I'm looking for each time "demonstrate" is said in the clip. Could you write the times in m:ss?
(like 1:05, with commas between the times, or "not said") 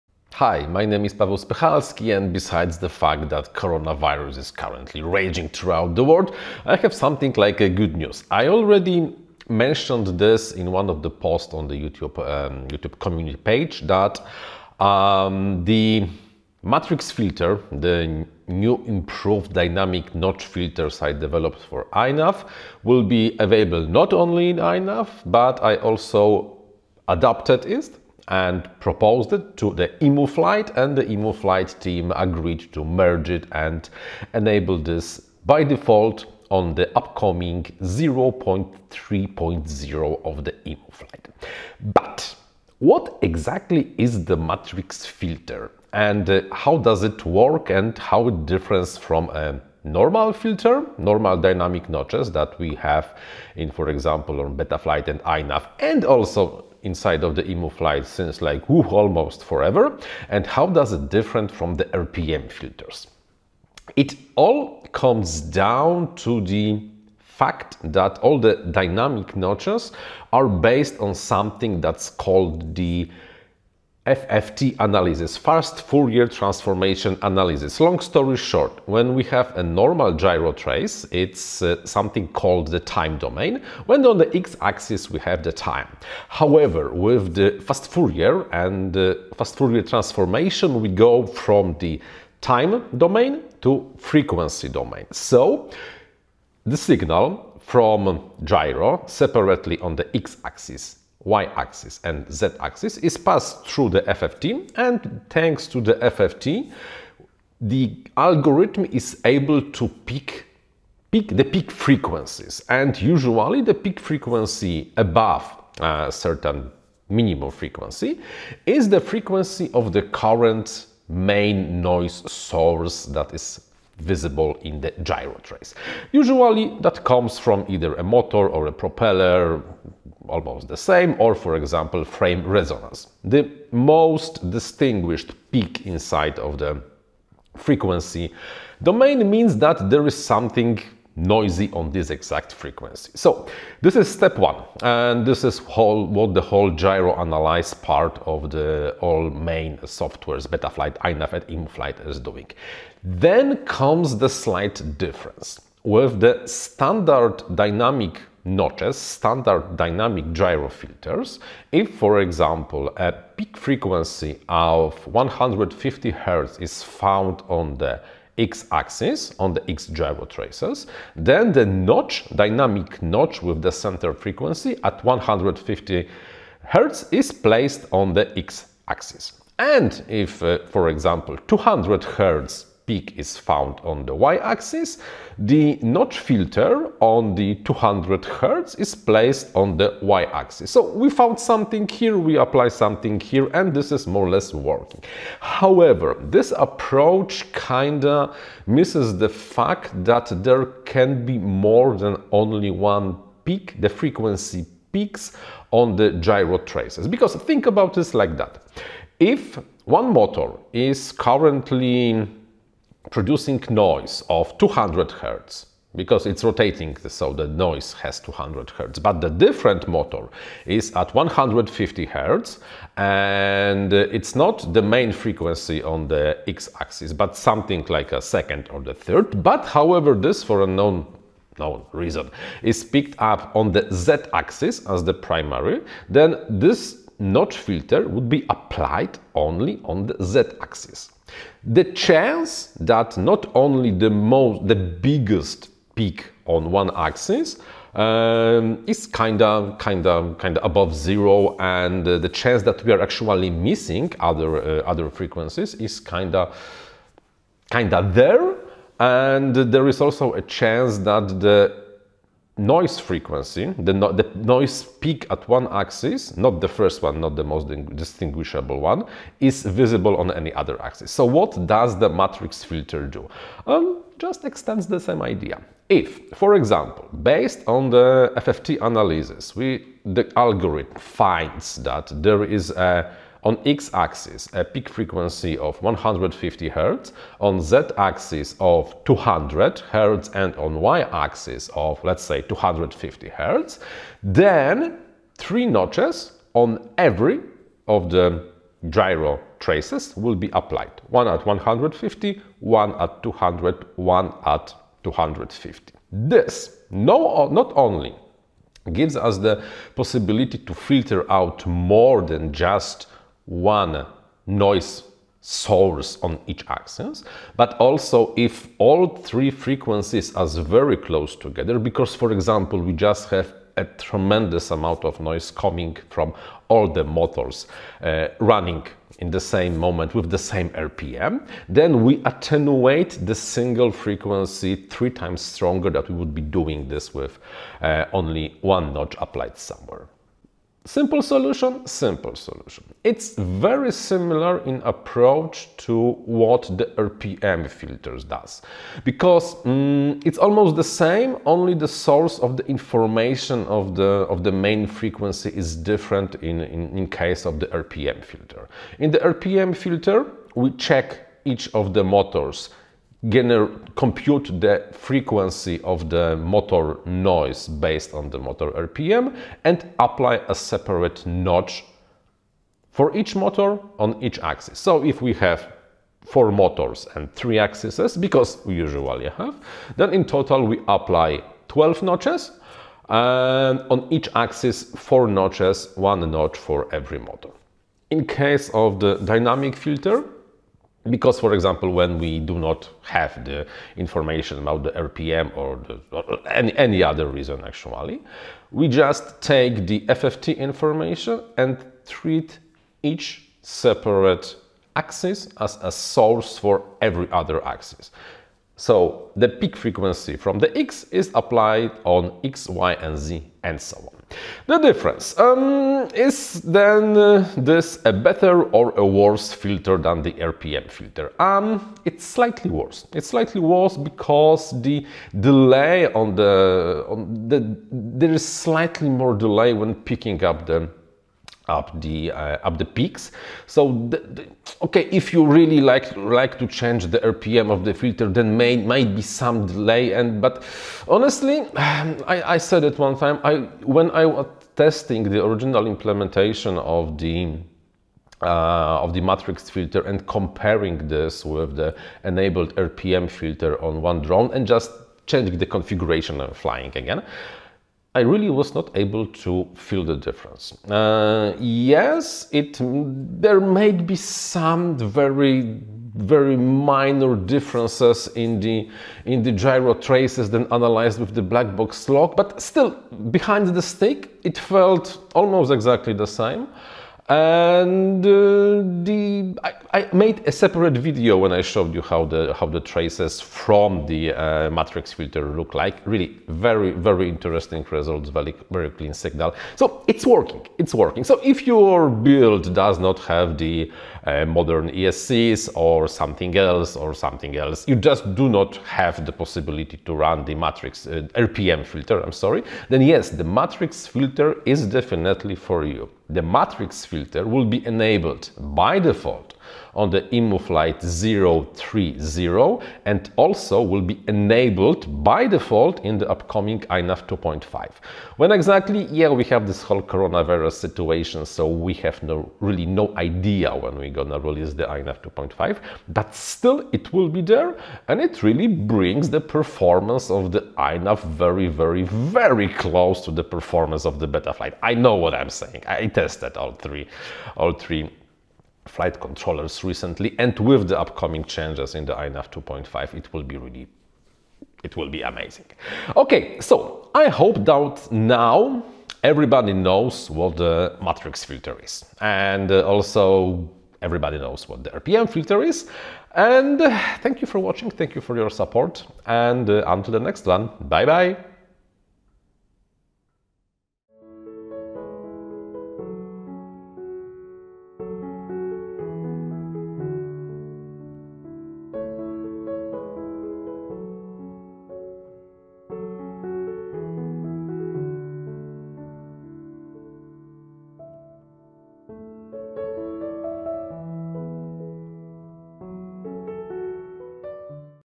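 not said.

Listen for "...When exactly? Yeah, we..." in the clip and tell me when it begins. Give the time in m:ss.
8:38.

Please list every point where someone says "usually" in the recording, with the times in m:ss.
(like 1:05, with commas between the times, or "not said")
1:52, 2:06, 6:18.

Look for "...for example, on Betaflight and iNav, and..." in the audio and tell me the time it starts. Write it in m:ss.
0:53.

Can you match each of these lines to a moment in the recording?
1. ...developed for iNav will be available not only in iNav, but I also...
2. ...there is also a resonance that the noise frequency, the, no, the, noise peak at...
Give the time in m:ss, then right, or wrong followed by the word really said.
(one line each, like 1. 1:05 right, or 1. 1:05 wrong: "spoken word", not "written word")
1. 0:21 right
2. 4:19 wrong: "chance", not "resonance".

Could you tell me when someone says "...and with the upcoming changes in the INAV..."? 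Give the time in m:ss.
9:00.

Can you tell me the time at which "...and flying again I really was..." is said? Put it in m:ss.
7:36.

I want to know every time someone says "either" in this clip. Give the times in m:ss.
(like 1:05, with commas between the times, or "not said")
2:07.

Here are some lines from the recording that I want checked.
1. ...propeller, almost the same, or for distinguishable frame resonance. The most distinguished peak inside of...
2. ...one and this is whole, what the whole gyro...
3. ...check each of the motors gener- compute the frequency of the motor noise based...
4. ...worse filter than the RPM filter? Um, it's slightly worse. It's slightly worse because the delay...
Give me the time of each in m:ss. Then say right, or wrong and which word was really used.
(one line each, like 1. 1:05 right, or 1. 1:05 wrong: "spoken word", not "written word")
1. 2:08 wrong: "example", not "distinguishable"
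2. 2:24 right
3. 6:00 right
4. 6:59 right.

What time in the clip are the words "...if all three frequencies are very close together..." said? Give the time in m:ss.
5:18.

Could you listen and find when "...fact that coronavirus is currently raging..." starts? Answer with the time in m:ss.
0:02.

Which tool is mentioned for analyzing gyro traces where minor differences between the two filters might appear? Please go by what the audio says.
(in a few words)
Blackbox log.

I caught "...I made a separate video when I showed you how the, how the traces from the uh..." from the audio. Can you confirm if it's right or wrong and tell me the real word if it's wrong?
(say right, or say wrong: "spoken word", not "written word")
right.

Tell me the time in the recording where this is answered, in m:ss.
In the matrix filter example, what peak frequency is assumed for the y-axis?
4:52.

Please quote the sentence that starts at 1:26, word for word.
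However, with the fast Fourier and uh, fast Fourier transformation, we go from the time domain to frequency domain.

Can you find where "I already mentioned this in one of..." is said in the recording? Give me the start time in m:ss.
0:08.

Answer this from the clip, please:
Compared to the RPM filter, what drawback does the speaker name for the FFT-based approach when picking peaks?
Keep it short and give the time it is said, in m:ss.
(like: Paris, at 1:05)
slightly more delay, at 7:08.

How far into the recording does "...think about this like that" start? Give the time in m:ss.
3:27.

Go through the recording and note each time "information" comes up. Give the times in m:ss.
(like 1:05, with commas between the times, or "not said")
5:52, 6:33, 6:40.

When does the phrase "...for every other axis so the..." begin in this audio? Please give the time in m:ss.
6:46.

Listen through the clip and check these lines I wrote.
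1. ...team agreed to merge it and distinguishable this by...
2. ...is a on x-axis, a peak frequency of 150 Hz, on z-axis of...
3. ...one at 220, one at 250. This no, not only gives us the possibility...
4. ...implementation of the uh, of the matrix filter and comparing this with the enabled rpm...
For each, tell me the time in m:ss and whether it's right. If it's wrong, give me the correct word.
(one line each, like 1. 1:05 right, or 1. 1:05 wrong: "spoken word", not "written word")
1. 0:31 wrong: "enable", not "distinguishable"
2. 4:42 right
3. 5:02 wrong: "200", not "220"
4. 7:25 right.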